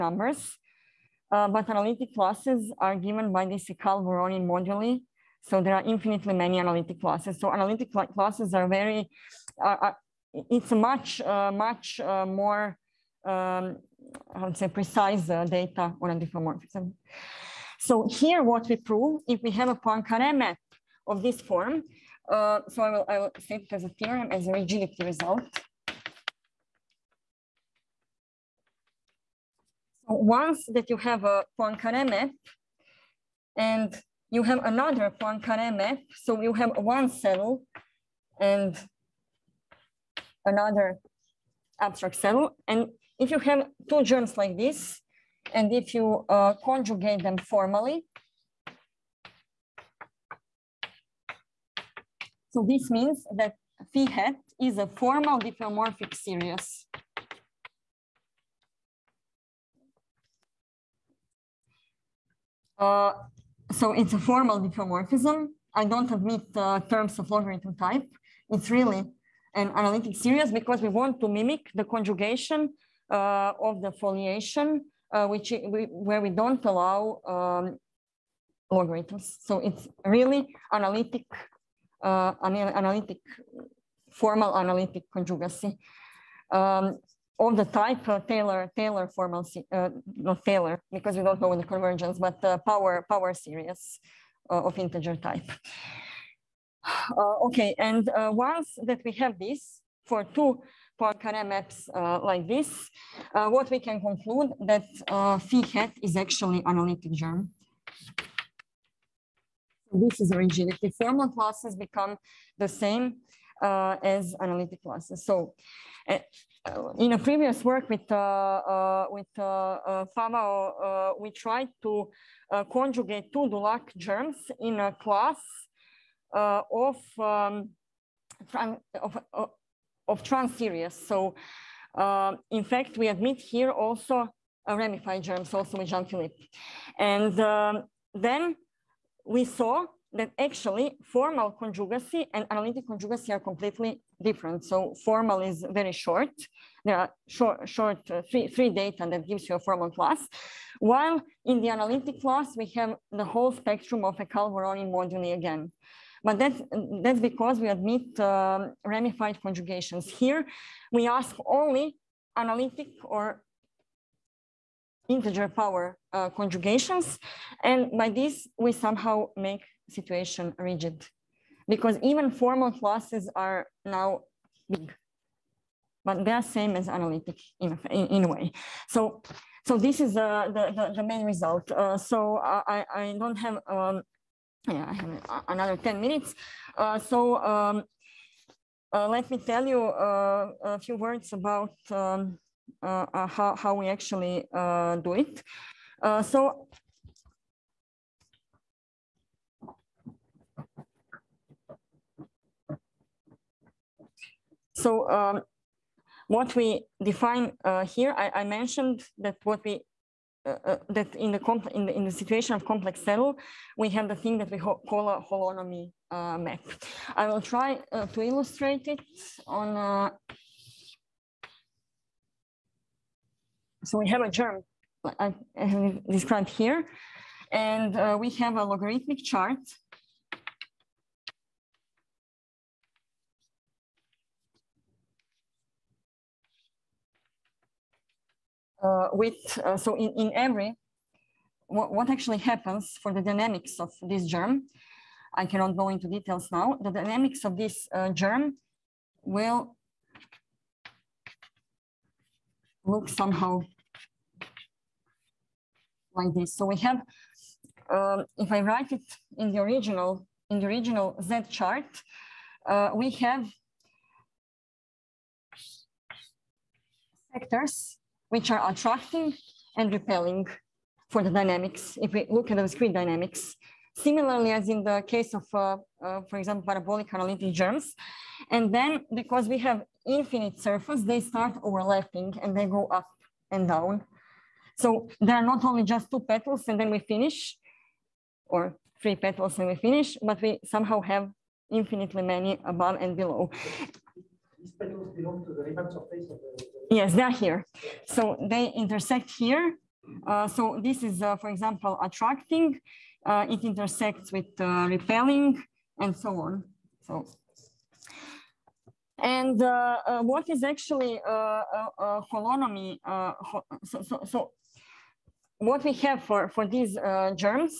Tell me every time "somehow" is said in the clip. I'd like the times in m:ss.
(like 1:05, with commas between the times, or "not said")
2:48, 4:13, 4:50.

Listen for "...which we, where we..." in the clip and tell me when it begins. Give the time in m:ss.
1:15.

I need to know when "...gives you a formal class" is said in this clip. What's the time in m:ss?
2:29.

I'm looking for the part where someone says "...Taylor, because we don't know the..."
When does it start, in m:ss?
1:30.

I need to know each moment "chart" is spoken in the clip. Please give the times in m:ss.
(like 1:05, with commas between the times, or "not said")
3:49, 4:21.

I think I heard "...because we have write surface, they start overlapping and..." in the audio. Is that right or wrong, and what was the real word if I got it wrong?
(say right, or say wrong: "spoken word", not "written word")
wrong: "infinite", not "write".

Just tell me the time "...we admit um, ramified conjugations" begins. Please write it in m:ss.
2:37.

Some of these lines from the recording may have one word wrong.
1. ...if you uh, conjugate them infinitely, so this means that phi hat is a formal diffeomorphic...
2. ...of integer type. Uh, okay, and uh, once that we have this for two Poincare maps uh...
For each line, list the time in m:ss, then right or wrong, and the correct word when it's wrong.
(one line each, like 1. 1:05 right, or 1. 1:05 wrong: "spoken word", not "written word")
1. 0:45 wrong: "formally", not "infinitely"
2. 1:34 right.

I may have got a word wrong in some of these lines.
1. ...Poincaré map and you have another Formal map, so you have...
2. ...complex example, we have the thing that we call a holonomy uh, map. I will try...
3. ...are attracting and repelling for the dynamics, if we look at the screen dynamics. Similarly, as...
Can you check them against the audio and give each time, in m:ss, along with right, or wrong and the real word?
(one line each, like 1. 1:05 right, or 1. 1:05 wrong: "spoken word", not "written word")
1. 0:31 wrong: "Poincaré", not "Formal"
2. 3:32 wrong: "saddle", not "example"
3. 4:28 right.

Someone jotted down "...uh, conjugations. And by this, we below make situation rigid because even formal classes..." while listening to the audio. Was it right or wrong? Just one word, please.
wrong.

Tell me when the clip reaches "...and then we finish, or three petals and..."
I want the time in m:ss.
4:46.